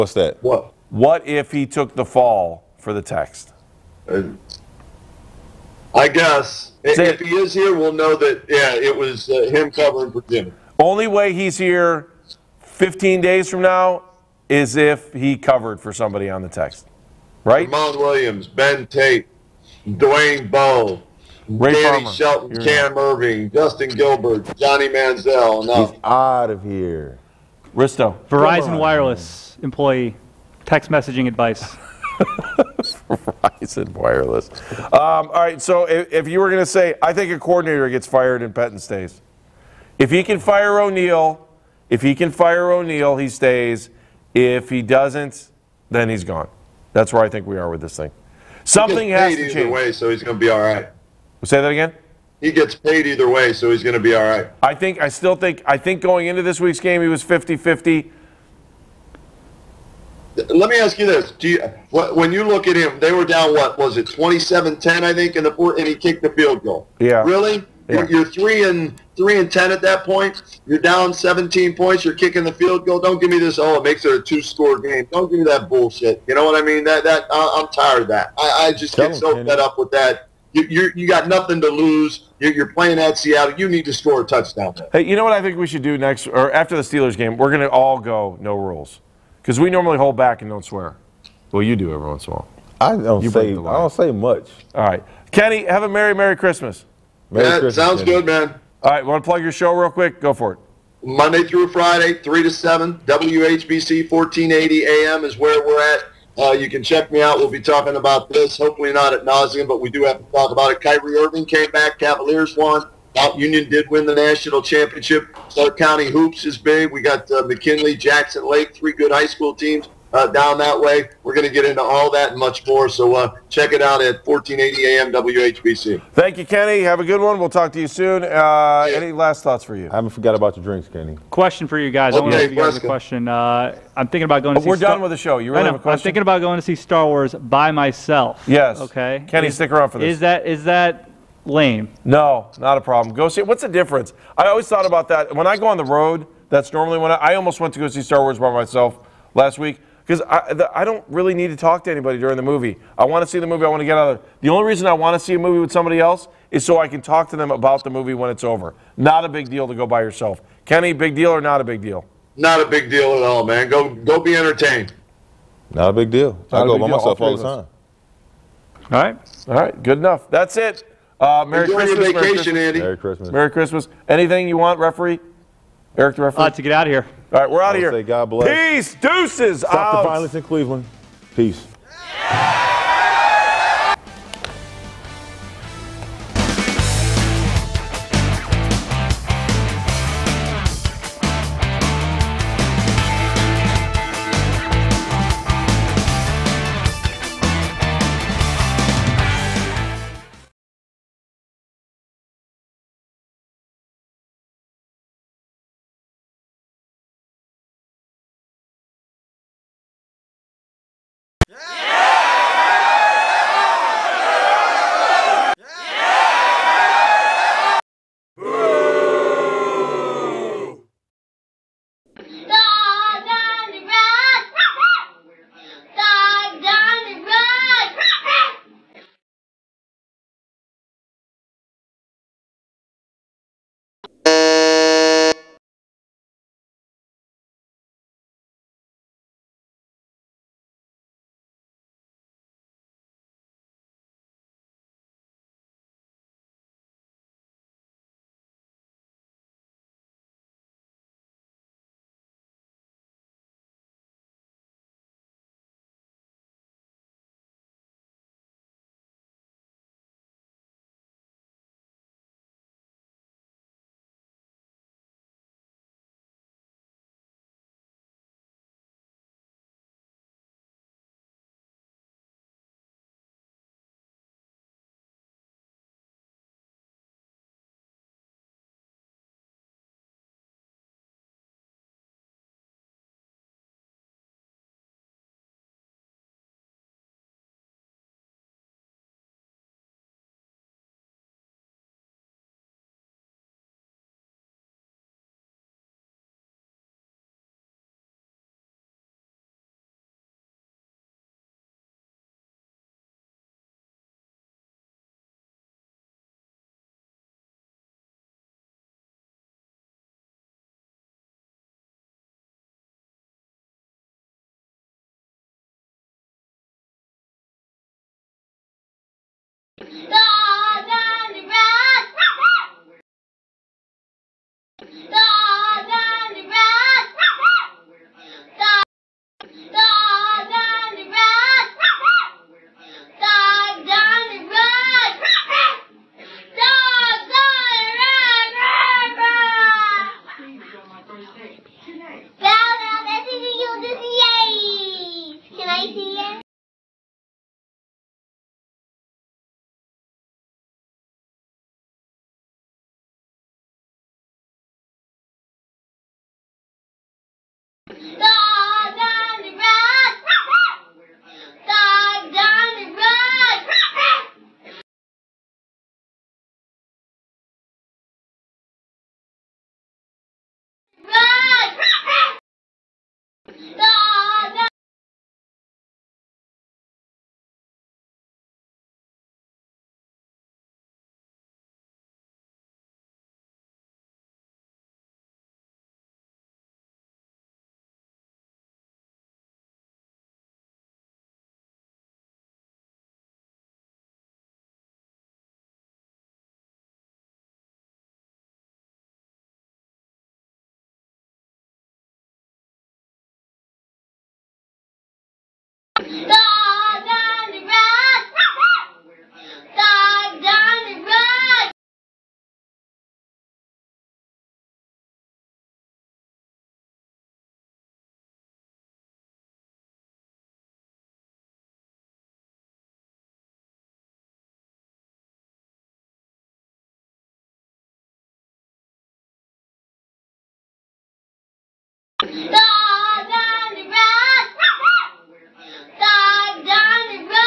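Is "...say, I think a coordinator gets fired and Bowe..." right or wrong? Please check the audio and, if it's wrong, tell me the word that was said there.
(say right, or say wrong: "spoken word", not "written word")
wrong: "Pettine", not "Bowe".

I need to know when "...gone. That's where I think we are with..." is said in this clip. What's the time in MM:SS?
00:46.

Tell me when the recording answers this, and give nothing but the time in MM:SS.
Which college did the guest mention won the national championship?
01:53.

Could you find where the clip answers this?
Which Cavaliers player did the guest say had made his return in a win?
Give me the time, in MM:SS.
01:50.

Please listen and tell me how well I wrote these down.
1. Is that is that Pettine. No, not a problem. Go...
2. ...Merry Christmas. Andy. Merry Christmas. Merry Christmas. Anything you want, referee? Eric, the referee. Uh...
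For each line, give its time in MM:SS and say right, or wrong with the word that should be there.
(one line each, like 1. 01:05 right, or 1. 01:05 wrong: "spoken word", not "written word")
1. 02:20 wrong: "Lame", not "Pettine"
2. 02:52 right.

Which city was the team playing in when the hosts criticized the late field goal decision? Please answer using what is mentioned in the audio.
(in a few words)
Seattle.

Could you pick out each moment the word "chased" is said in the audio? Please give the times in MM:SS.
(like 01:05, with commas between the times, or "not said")
not said.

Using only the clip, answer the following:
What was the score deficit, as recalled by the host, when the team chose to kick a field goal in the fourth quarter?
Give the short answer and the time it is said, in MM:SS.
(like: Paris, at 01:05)
27-10, at 01:04.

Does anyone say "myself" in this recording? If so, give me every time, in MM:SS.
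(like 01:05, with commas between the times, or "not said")
02:17, 02:28, 02:46.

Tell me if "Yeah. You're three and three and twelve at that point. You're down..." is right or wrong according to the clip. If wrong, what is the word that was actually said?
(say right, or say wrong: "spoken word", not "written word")
wrong: "ten", not "twelve".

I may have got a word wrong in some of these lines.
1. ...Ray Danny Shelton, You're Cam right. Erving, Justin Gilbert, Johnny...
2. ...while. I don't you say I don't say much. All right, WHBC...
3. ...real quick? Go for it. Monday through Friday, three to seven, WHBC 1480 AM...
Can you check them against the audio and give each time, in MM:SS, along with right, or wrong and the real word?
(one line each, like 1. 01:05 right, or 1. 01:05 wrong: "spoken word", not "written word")
1. 00:21 right
2. 01:32 wrong: "Kenny", not "WHBC"
3. 01:39 right.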